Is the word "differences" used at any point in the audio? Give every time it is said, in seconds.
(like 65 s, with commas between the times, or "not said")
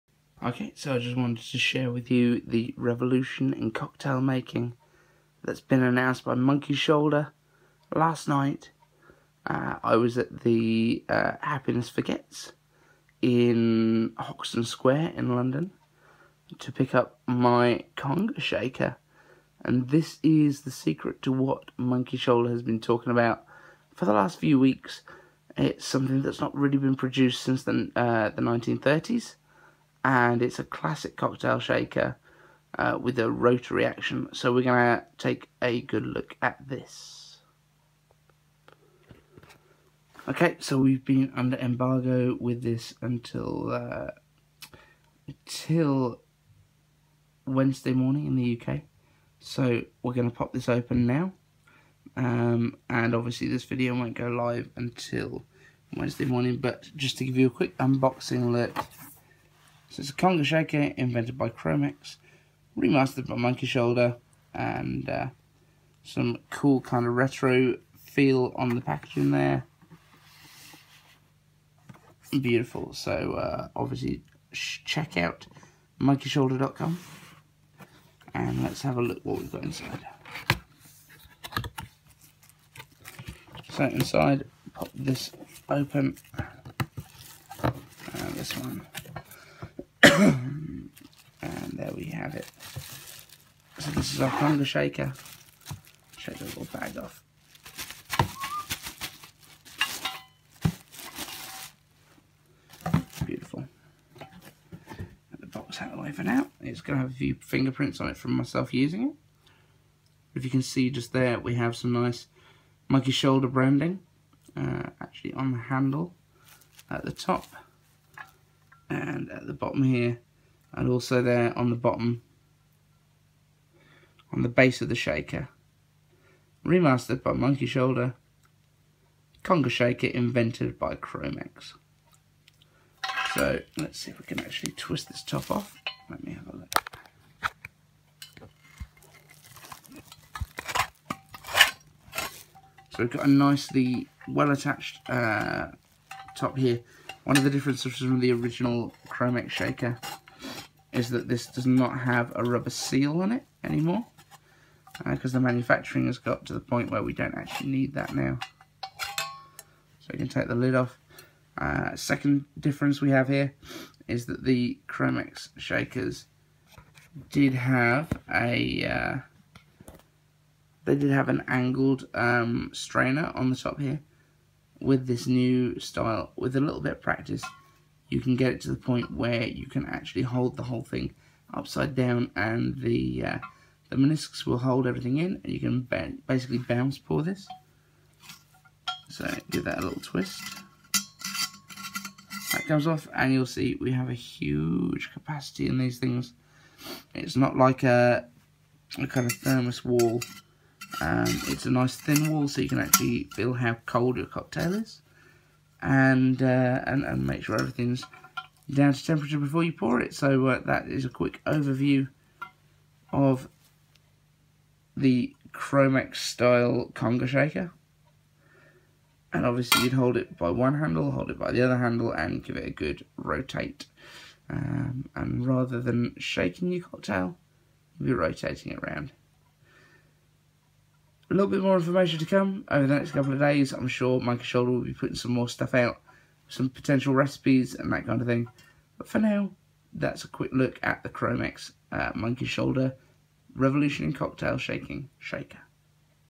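147 s, 162 s.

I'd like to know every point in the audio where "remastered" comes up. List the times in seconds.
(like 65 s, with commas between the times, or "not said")
62 s, 126 s.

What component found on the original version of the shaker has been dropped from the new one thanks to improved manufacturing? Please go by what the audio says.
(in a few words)
rubber seal.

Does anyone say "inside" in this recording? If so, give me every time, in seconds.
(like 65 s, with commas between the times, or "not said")
79 s, 83 s.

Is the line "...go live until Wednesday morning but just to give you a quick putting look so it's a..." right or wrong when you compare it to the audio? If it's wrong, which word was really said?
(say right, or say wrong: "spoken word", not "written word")
wrong: "unboxing", not "putting".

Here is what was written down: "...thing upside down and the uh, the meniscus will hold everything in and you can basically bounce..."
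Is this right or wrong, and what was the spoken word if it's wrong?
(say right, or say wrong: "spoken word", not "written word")
right.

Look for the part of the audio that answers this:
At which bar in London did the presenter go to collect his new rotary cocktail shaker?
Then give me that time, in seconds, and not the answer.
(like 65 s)
11 s.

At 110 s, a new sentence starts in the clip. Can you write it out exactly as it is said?
If you can see just there, we have some nice monkey shoulder branding.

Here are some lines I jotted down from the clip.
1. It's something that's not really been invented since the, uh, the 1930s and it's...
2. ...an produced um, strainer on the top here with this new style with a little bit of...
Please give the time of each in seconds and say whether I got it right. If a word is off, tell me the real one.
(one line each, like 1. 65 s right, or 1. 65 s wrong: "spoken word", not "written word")
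1. 25 s wrong: "produced", not "invented"
2. 171 s wrong: "angled", not "produced".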